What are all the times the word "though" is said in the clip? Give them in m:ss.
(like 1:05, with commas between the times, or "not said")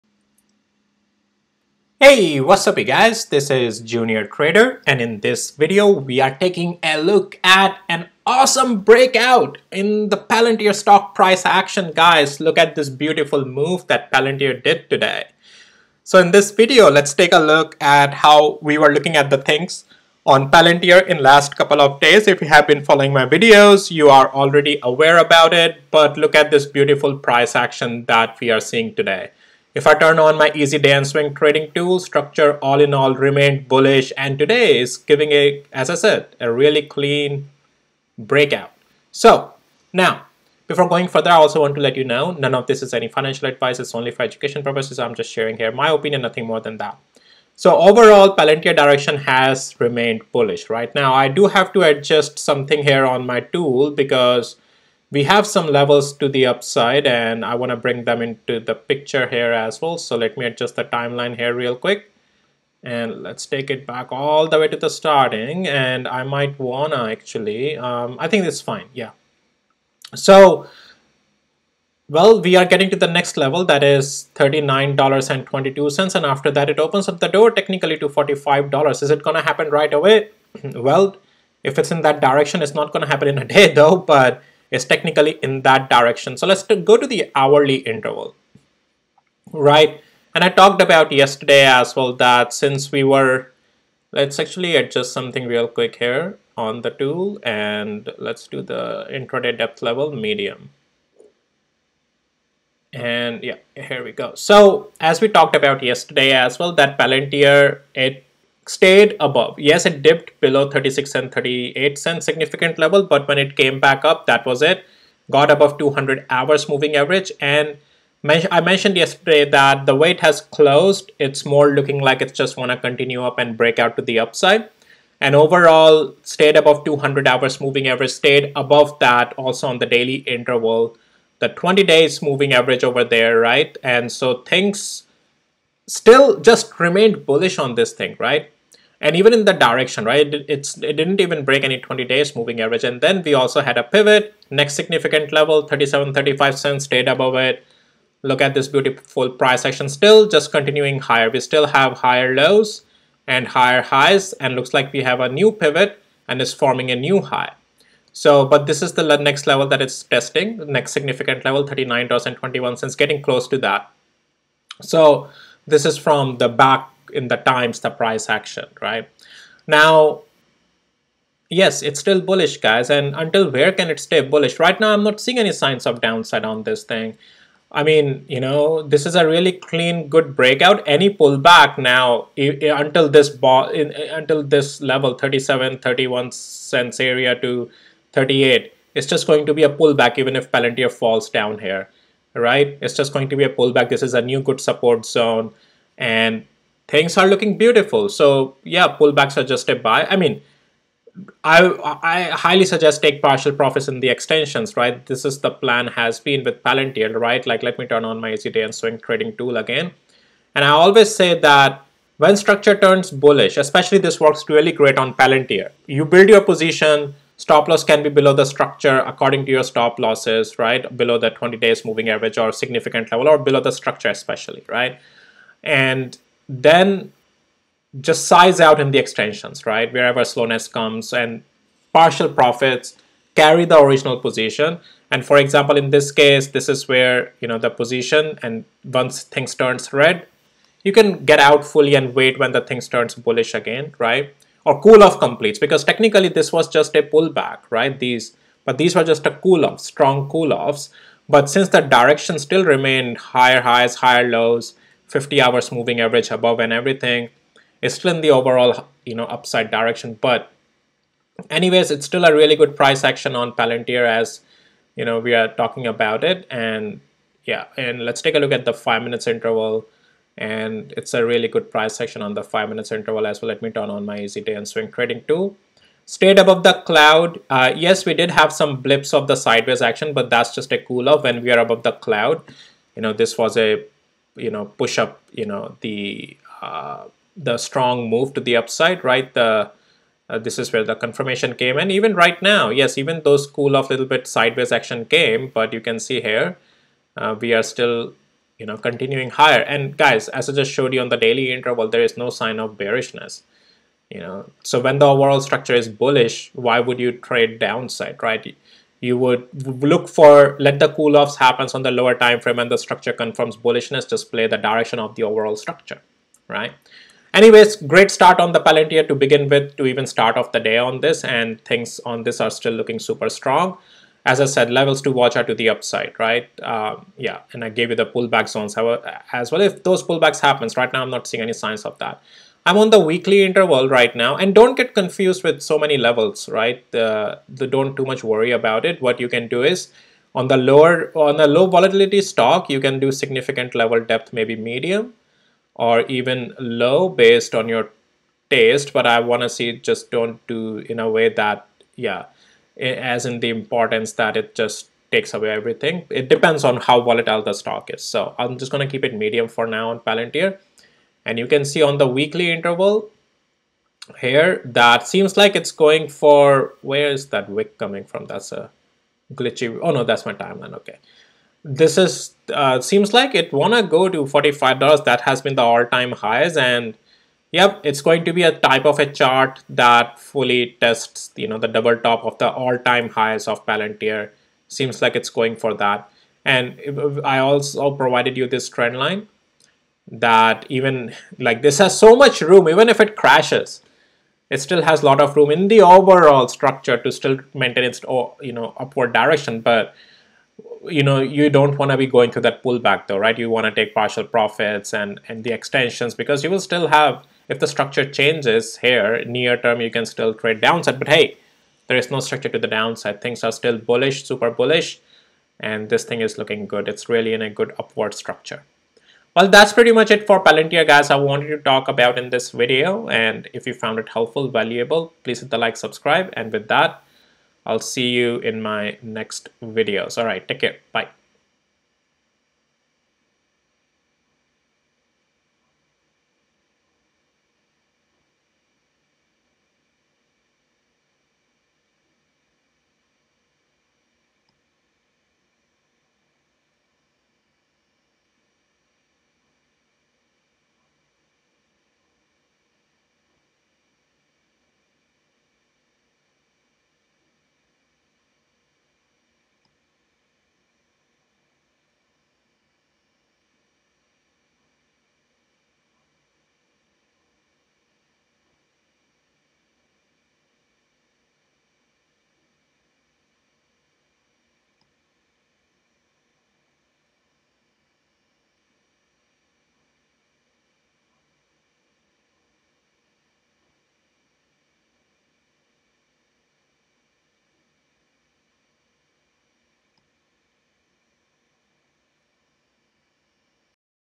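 1:23, 6:43.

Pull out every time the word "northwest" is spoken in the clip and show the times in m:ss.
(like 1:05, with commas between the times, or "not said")
not said.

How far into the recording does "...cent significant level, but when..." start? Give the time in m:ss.
1:51.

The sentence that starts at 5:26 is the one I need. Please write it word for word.
Um, yeah, and I gave you the pullback zones as well.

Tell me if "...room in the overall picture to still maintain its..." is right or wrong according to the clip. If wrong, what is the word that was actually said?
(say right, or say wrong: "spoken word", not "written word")
wrong: "structure", not "picture".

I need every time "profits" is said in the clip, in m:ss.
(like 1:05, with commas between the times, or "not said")
3:23, 3:52, 6:44.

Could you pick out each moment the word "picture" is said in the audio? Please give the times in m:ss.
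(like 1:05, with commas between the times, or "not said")
0:58.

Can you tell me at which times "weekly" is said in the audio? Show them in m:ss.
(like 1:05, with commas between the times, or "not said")
5:32, 6:02.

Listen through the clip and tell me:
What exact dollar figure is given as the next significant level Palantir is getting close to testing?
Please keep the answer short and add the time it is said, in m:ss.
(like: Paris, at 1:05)
$39.21, at 2:41.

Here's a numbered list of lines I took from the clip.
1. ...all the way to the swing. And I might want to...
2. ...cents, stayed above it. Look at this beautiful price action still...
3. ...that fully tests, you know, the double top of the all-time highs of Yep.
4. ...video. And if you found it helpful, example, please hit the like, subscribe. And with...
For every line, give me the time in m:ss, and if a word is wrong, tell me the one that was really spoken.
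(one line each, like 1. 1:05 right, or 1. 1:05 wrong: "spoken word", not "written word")
1. 1:04 wrong: "starting", not "swing"
2. 2:26 right
3. 6:19 wrong: "Palantir", not "Yep"
4. 7:02 wrong: "valuable", not "example".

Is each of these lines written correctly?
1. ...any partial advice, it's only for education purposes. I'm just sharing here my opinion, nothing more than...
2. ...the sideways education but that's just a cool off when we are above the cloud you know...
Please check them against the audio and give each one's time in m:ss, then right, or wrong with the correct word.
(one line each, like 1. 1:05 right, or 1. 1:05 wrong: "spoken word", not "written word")
1. 0:42 wrong: "financial", not "partial"
2. 4:39 wrong: "action", not "education".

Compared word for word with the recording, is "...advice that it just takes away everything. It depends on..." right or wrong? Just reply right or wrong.
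wrong.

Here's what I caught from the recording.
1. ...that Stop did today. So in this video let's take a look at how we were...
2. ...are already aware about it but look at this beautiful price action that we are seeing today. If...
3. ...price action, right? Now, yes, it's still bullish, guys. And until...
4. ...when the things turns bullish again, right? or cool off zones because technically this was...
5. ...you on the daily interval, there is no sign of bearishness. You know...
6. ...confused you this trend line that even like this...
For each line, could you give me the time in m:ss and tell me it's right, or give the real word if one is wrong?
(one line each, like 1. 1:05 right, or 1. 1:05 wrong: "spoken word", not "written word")
1. 0:13 wrong: "Palantir", not "Stop"
2. 0:24 right
3. 2:47 right
4. 4:02 wrong: "completes", not "zones"
5. 5:00 right
6. 6:27 wrong: "provided", not "confused".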